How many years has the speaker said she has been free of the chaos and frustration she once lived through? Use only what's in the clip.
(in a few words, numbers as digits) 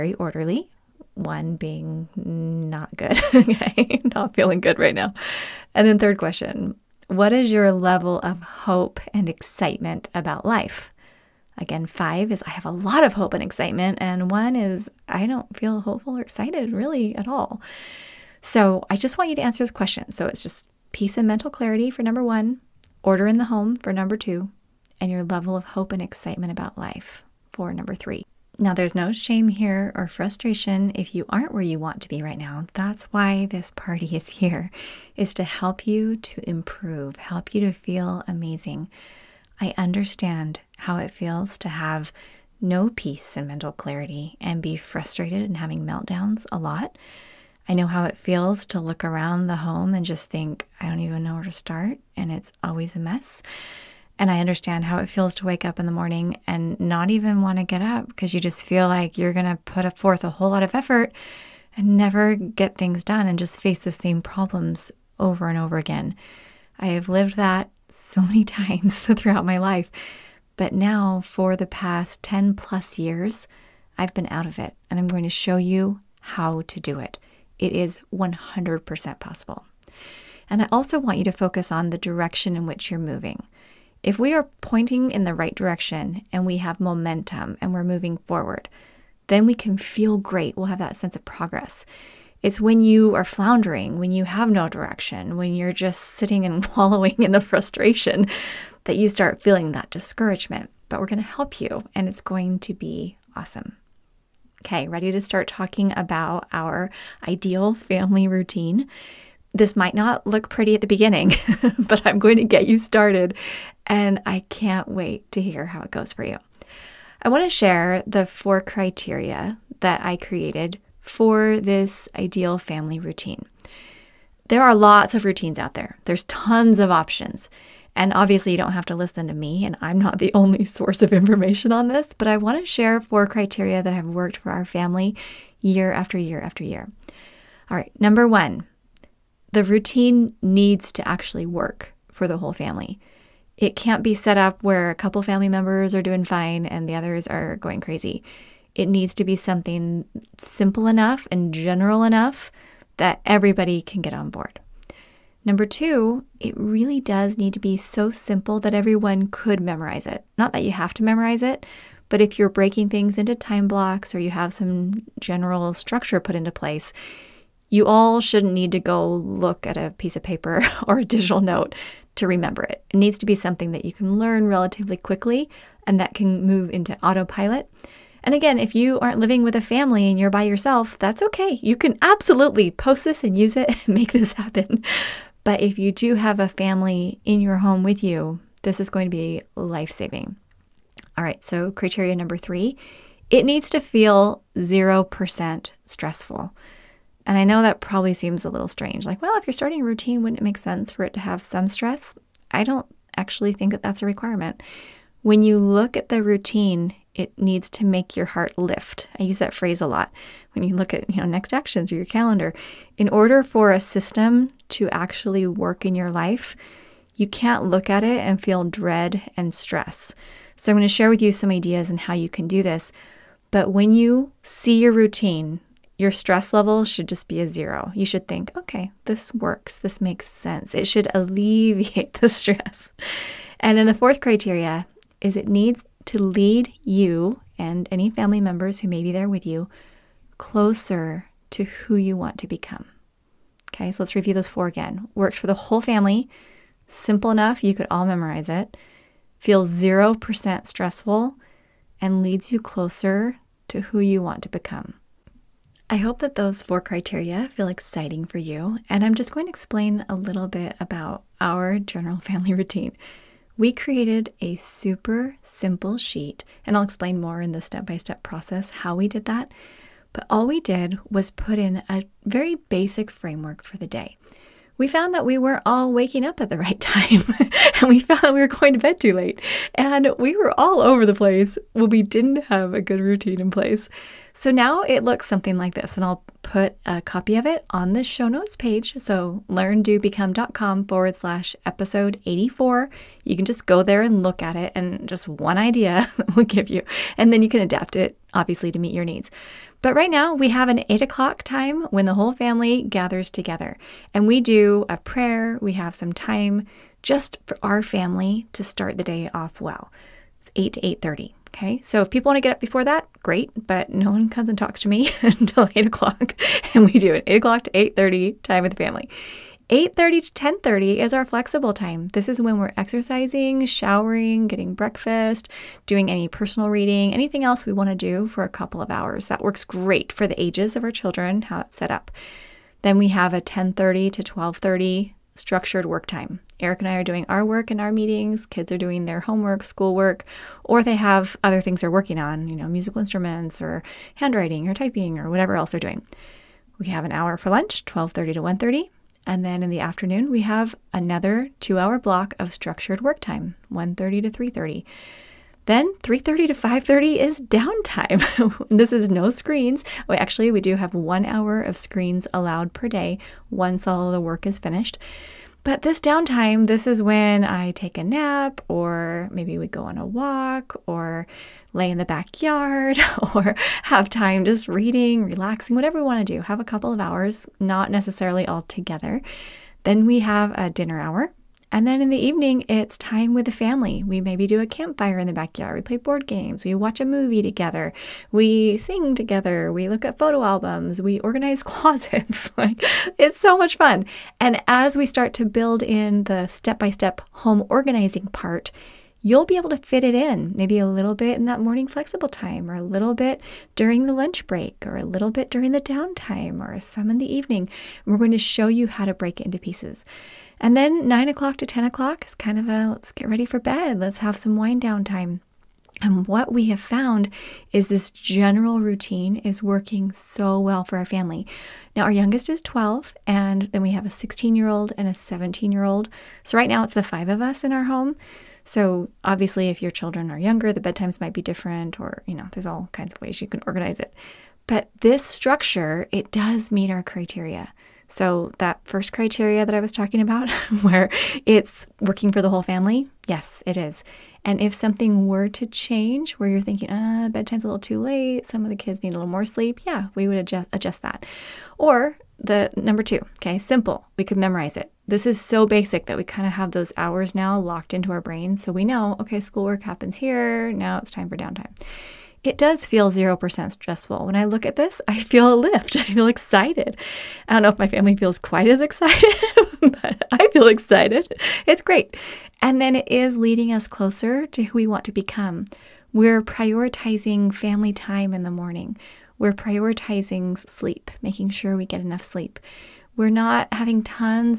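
10 plus years.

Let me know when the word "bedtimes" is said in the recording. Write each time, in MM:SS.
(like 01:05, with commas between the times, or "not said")
07:10, 07:27.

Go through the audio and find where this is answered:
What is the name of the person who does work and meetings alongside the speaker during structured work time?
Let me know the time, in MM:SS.
05:36.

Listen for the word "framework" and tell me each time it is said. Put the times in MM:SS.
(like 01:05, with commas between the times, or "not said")
04:33.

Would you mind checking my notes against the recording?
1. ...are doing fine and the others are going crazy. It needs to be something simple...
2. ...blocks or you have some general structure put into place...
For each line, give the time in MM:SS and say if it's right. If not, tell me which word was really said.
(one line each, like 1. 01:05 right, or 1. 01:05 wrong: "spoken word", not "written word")
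1. 02:25 right
2. 02:43 right.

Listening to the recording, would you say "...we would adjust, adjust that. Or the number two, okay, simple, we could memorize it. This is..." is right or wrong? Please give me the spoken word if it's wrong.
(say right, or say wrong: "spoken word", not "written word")
right.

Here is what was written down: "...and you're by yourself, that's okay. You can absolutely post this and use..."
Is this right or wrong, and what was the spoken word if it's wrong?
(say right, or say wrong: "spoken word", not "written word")
right.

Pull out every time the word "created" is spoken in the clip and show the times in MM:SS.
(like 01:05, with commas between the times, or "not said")
02:00, 04:23.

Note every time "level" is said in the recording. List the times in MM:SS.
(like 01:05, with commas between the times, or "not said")
00:07, 00:25, 03:46.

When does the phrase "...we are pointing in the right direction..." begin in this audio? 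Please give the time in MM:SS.
01:24.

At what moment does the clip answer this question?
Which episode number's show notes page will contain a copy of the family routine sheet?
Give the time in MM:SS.
04:51.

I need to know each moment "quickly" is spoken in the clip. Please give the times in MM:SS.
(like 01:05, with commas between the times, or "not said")
02:54.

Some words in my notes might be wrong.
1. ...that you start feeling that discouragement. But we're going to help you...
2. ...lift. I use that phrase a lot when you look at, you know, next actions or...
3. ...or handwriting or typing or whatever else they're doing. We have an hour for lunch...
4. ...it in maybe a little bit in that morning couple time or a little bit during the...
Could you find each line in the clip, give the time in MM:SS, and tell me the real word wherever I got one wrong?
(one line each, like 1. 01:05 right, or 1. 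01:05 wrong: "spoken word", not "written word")
1. 01:38 right
2. 03:28 right
3. 05:43 right
4. 06:40 wrong: "flexible", not "couple".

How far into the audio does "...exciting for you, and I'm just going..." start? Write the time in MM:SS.
04:17.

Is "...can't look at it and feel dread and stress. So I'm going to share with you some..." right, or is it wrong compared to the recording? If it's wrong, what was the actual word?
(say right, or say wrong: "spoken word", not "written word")
right.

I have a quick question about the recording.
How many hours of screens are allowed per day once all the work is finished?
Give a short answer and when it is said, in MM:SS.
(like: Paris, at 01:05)
1, at 06:00.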